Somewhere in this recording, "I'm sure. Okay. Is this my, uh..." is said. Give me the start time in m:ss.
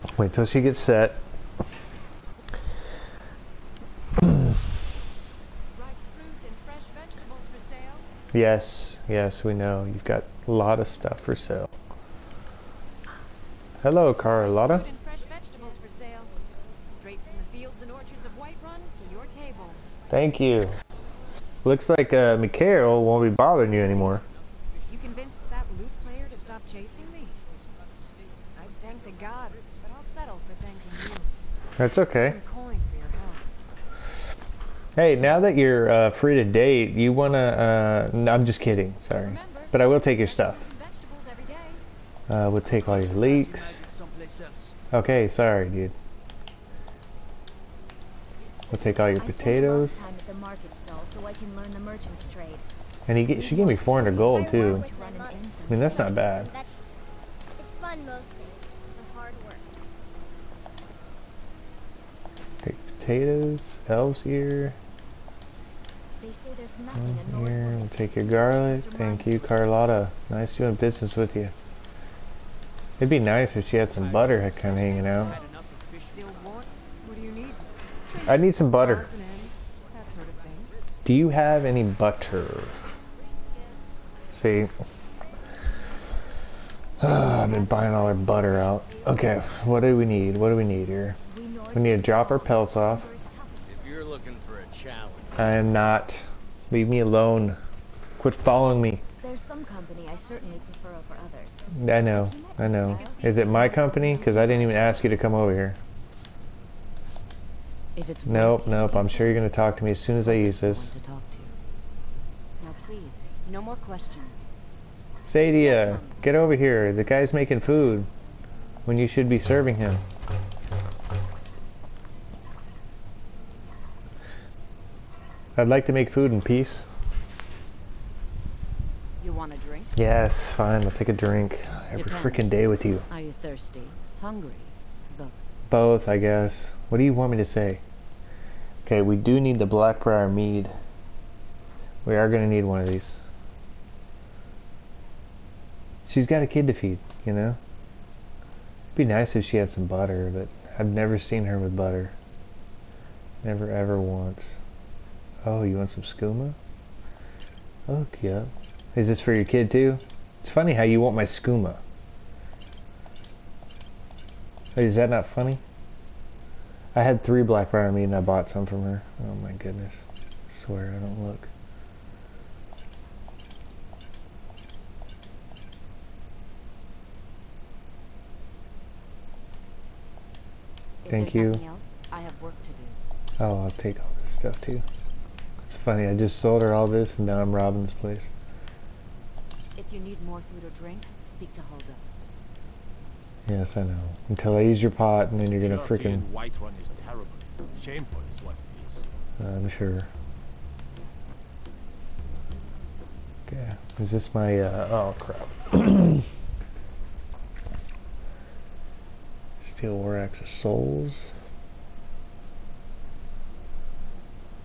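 3:19.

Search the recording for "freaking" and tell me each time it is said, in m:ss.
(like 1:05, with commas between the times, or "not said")
2:12, 3:15.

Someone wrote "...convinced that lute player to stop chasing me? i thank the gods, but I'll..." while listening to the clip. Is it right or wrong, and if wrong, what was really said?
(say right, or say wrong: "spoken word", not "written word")
right.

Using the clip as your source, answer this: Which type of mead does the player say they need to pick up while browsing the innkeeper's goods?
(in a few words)
Blackbriar.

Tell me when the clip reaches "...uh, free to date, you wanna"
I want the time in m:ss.
0:35.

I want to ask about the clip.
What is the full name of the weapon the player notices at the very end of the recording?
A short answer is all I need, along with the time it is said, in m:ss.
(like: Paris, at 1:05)
Steel War Axe of Souls, at 3:29.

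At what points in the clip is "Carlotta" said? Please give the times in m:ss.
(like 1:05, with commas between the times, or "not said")
0:14, 1:09.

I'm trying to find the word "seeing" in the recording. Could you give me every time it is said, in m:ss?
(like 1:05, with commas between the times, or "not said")
not said.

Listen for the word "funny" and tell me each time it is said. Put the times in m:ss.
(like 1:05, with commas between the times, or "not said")
2:40, 2:45, 3:05.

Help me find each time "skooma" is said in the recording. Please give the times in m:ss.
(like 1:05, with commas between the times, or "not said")
2:36, 2:41.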